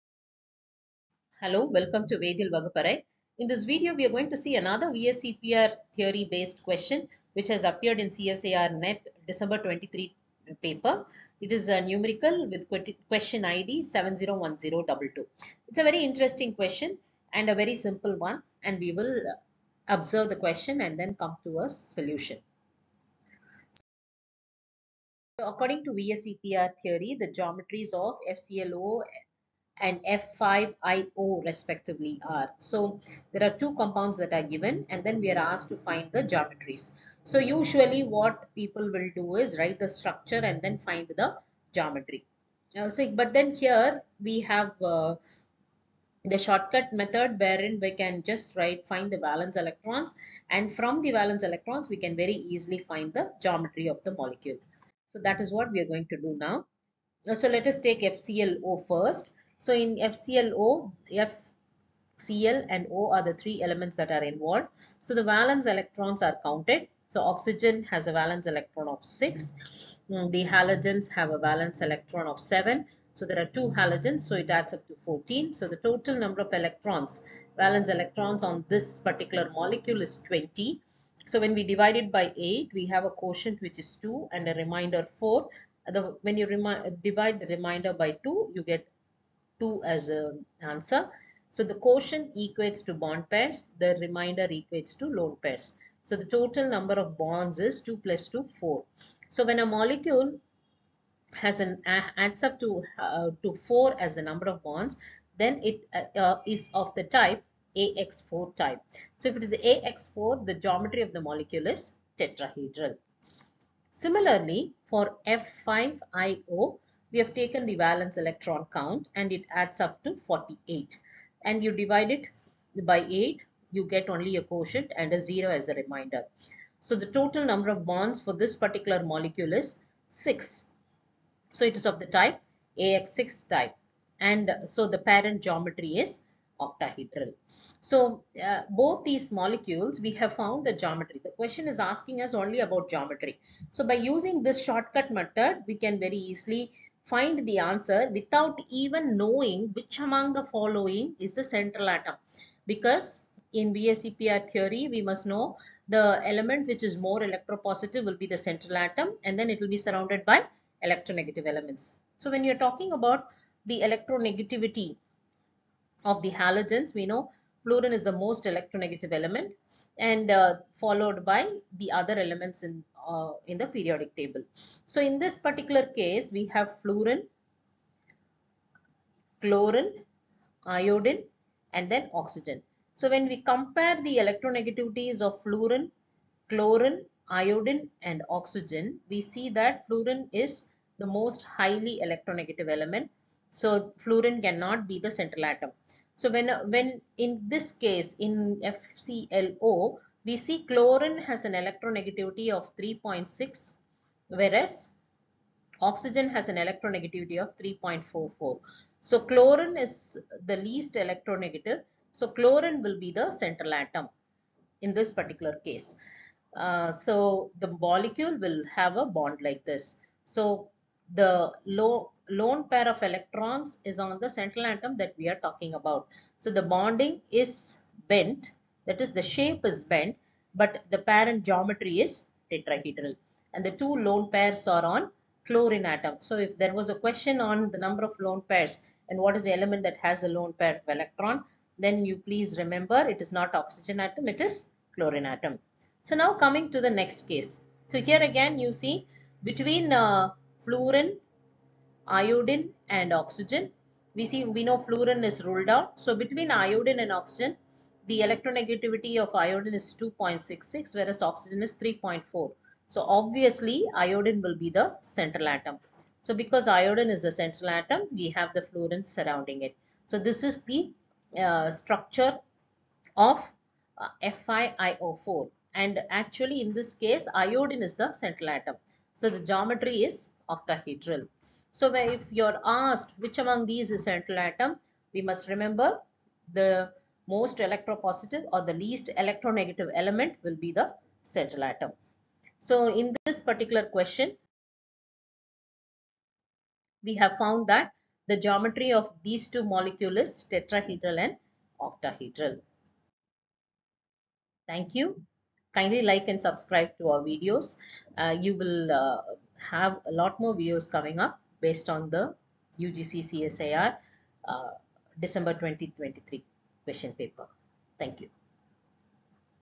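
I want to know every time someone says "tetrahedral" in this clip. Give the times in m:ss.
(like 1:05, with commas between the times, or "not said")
1:52, 3:52, 5:00.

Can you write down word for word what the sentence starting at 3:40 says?
So the low, lone pair of electrons is on the central atom that we are talking about.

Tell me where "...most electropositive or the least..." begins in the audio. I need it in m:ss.
4:47.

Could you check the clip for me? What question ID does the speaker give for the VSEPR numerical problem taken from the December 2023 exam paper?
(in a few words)
701022.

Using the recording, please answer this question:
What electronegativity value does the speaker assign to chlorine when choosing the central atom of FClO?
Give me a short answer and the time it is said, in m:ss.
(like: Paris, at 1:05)
3.6, at 3:22.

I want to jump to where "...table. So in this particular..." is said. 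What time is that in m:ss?
2:54.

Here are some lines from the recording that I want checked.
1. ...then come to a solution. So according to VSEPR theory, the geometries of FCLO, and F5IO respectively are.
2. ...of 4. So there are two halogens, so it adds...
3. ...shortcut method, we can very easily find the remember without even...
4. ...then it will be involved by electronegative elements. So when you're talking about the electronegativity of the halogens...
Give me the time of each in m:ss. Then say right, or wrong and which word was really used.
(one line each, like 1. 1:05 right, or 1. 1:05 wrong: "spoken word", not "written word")
1. 0:20 right
2. 1:12 wrong: "7", not "4"
3. 2:24 wrong: "answer", not "remember"
4. 2:39 wrong: "surrounded", not "involved".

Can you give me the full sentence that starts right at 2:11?
So it is of the type AX6 type and so the parent geometry is octahedral.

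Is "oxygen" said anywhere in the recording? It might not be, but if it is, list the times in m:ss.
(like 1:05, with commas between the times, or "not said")
1:07, 3:02, 3:08, 3:25, 4:03, 4:13, 4:17, 4:21.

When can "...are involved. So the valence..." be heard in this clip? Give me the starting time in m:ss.
1:04.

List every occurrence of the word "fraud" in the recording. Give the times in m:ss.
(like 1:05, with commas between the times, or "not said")
not said.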